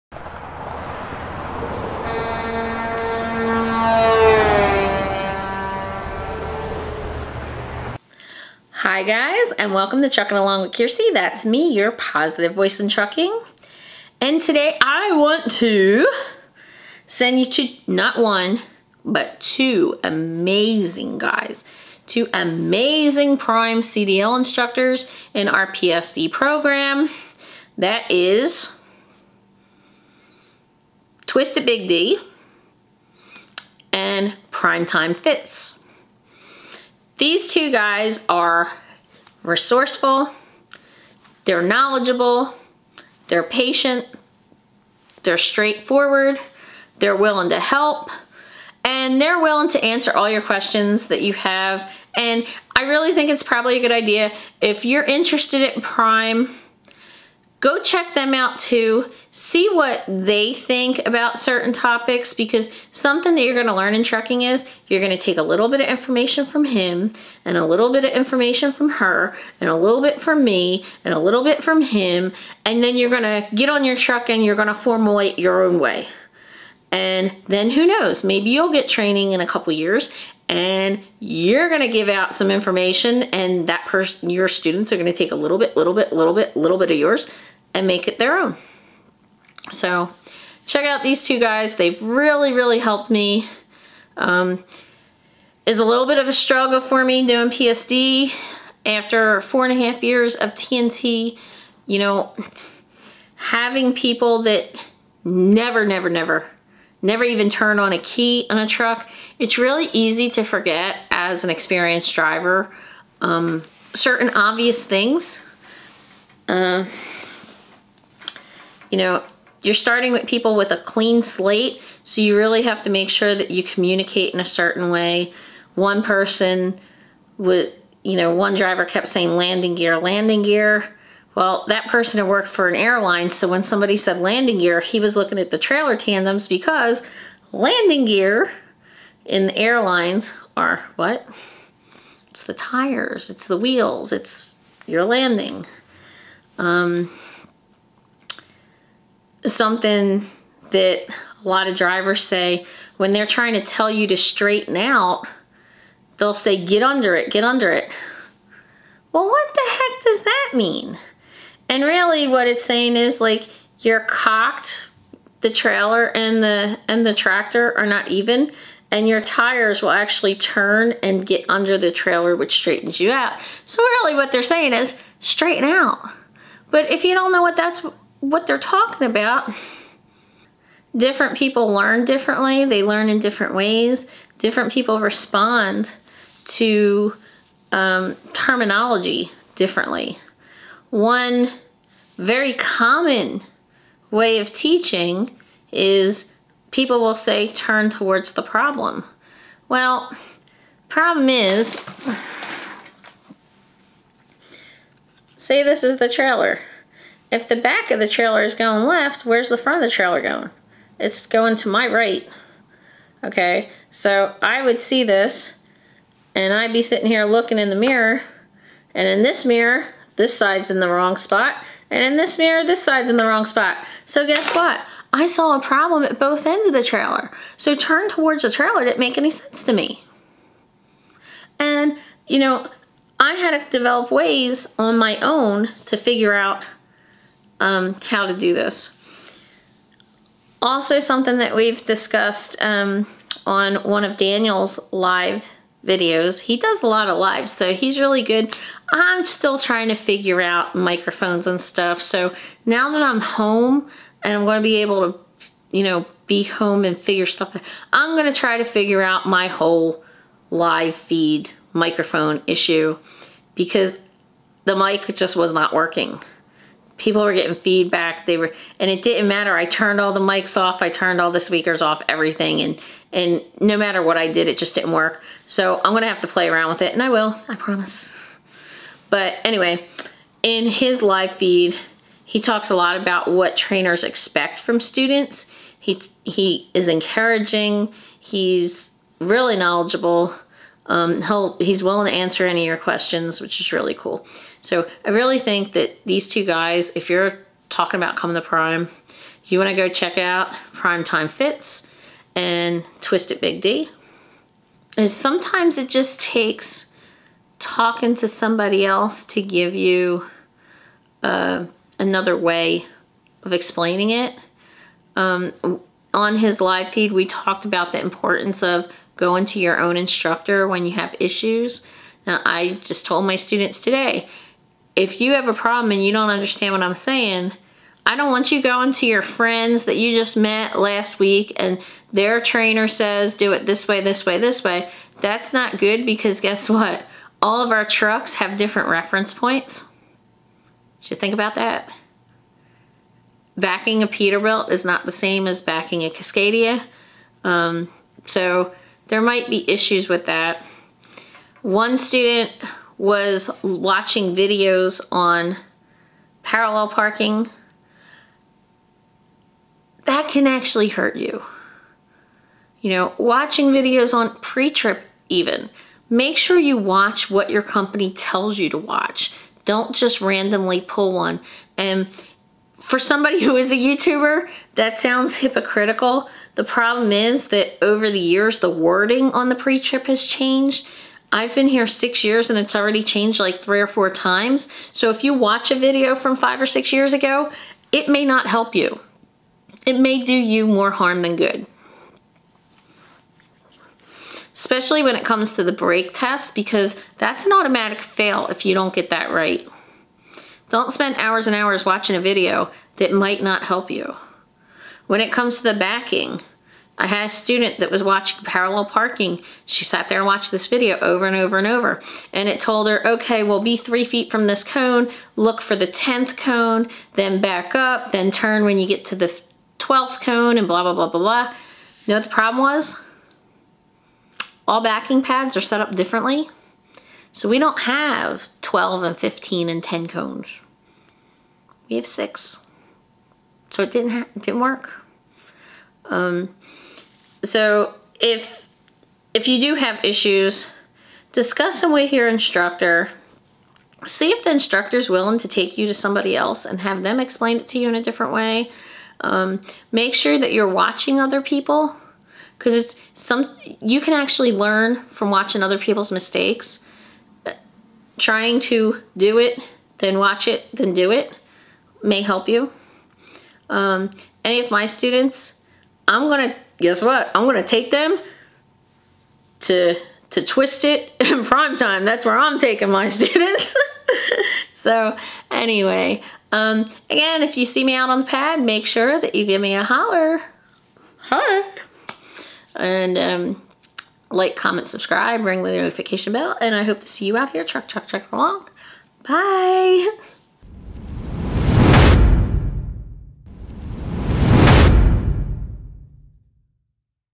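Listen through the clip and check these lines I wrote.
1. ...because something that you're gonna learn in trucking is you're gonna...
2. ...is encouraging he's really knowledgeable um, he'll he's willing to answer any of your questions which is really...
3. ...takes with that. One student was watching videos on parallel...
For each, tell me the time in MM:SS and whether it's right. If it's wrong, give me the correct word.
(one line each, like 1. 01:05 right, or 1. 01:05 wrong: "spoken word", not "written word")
1. 01:02 right
2. 04:46 right
3. 05:49 wrong: "issues", not "takes".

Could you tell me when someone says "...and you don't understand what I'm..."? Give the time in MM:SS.
05:25.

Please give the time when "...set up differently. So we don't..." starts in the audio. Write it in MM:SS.
07:05.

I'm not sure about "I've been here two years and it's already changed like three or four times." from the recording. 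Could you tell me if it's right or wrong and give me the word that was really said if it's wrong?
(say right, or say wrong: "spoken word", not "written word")
wrong: "six", not "two".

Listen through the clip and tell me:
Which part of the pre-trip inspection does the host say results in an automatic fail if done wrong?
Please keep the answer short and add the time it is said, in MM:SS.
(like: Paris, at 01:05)
the brake test, at 06:35.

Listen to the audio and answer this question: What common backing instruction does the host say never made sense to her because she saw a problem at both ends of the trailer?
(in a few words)
turn towards the problem.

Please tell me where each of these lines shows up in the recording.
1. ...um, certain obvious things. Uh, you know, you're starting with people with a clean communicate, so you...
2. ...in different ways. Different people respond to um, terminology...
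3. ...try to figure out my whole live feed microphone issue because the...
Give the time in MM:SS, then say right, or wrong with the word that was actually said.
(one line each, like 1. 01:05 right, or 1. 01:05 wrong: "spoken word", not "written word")
1. 01:53 wrong: "slate", not "communicate"
2. 03:03 right
3. 04:18 right.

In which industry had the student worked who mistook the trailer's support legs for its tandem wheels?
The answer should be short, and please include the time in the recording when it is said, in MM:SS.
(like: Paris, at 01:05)
airline, at 02:12.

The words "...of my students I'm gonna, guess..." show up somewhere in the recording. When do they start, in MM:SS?
07:44.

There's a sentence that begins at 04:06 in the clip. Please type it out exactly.
He does a lot of lives, so he's really good.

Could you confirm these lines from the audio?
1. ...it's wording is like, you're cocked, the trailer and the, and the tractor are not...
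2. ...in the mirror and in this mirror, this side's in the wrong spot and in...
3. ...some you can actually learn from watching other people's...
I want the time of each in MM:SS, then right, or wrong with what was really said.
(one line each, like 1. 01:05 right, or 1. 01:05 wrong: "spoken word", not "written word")
1. 02:42 wrong: "saying", not "wording"
2. 03:37 right
3. 07:33 right.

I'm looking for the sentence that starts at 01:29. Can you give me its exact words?
So check out these two guys.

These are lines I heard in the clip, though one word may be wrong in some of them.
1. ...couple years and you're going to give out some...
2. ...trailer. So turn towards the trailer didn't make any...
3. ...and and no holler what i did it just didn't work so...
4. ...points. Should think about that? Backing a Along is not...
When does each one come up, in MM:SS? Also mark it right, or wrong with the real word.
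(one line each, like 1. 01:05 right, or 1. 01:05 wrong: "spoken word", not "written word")
1. 01:19 right
2. 03:46 right
3. 04:32 wrong: "matter", not "holler"
4. 05:39 wrong: "Peterbilt", not "Along".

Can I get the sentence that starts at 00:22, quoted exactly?
Two amazing prime CDL instructors in our PSD program.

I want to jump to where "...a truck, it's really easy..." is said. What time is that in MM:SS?
01:48.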